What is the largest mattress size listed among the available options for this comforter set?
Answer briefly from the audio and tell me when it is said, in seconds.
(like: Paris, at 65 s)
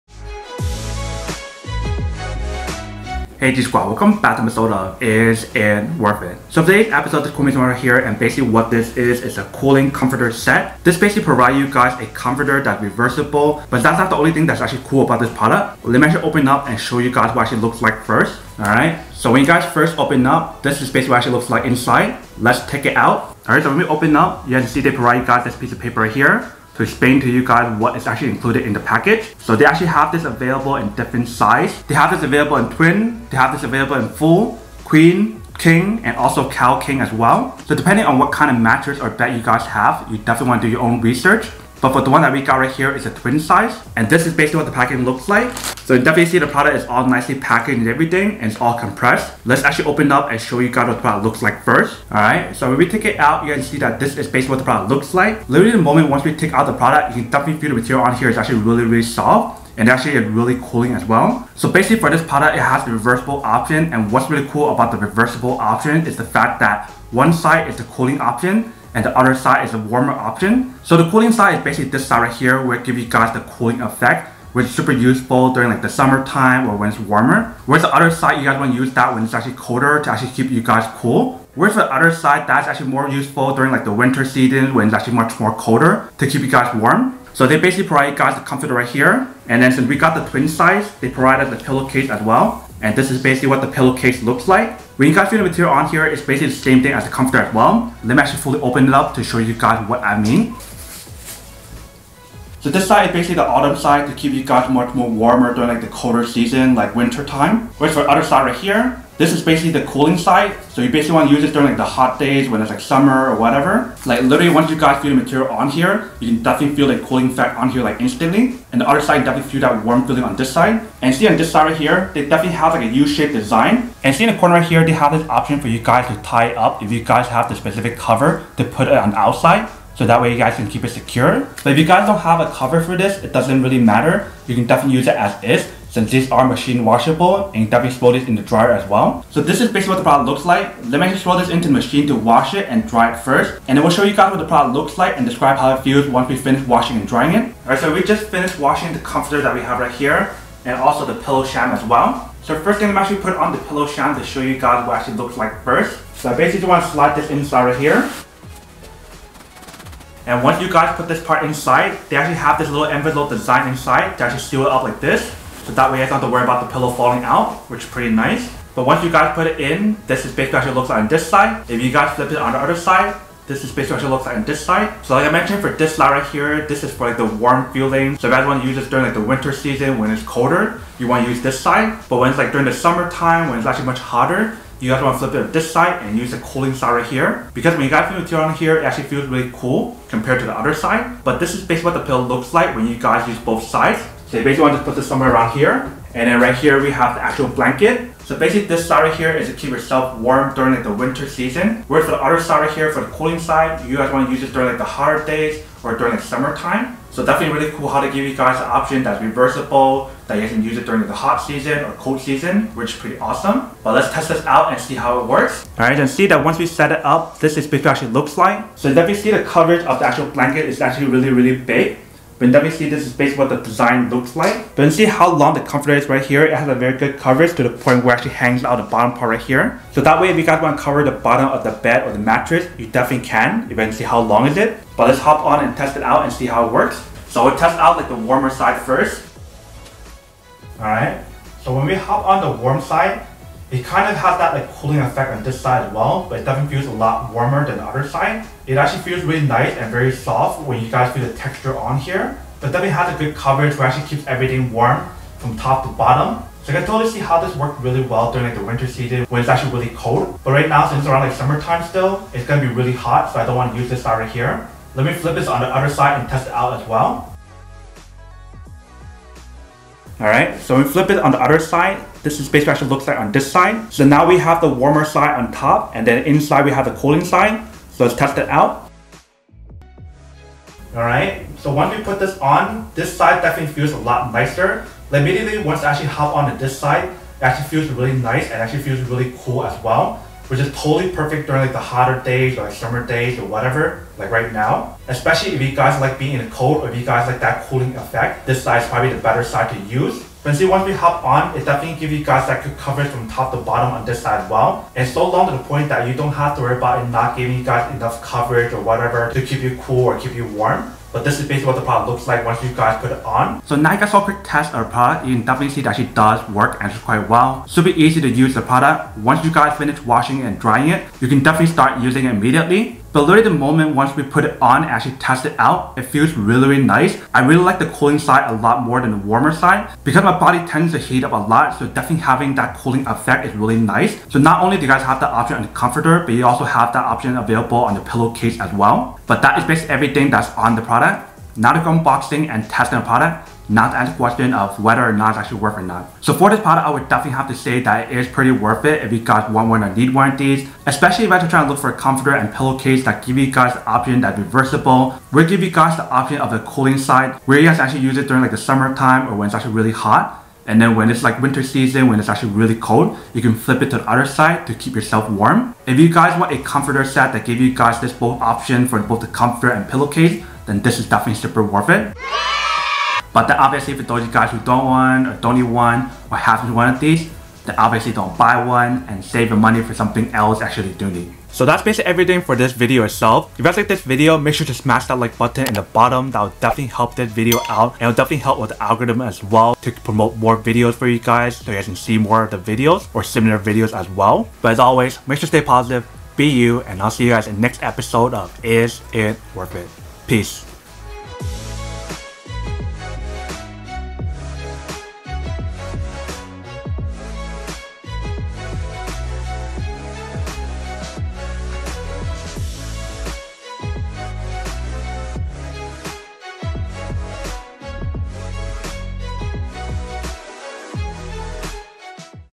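Cal king, at 36 s.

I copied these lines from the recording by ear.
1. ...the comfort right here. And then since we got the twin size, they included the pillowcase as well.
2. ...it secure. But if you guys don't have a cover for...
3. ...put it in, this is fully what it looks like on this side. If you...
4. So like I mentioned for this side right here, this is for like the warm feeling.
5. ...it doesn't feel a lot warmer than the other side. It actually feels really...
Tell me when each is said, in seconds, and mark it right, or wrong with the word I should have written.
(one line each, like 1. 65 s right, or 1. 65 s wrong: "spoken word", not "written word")
1. 88 s wrong: "provided", not "included"
2. 130 s right
3. 169 s wrong: "basically", not "fully"
4. 175 s right
5. 246 s right.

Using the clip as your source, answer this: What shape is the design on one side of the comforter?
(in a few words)
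U-shaped.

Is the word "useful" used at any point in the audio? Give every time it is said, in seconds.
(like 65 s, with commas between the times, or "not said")
74 s, 83 s.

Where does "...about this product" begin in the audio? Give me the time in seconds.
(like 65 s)
15 s.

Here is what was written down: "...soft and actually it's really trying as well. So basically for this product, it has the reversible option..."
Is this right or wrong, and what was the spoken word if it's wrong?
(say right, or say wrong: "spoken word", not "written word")
wrong: "cooling", not "trying".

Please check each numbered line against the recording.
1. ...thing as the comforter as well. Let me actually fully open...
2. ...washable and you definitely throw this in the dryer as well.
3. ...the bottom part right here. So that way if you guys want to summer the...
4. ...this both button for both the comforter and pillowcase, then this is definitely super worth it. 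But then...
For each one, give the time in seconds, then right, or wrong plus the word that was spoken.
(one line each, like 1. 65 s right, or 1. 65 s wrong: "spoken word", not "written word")
1. 96 s right
2. 136 s right
3. 228 s wrong: "cover", not "summer"
4. 367 s wrong: "option", not "button".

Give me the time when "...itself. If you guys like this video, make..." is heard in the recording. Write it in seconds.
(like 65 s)
383 s.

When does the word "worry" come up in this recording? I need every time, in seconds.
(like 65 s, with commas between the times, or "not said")
166 s, 306 s.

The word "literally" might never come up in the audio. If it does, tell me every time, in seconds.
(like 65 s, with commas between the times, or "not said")
55 s, 114 s, 323 s.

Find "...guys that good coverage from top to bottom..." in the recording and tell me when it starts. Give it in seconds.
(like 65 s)
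302 s.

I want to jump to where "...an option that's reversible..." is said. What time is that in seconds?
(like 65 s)
208 s.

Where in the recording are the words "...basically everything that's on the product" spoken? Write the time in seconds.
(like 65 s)
339 s.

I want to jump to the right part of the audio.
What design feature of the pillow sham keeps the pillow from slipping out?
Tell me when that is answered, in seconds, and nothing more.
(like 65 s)
162 s.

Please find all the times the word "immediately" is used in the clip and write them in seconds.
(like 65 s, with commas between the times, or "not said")
285 s, 322 s.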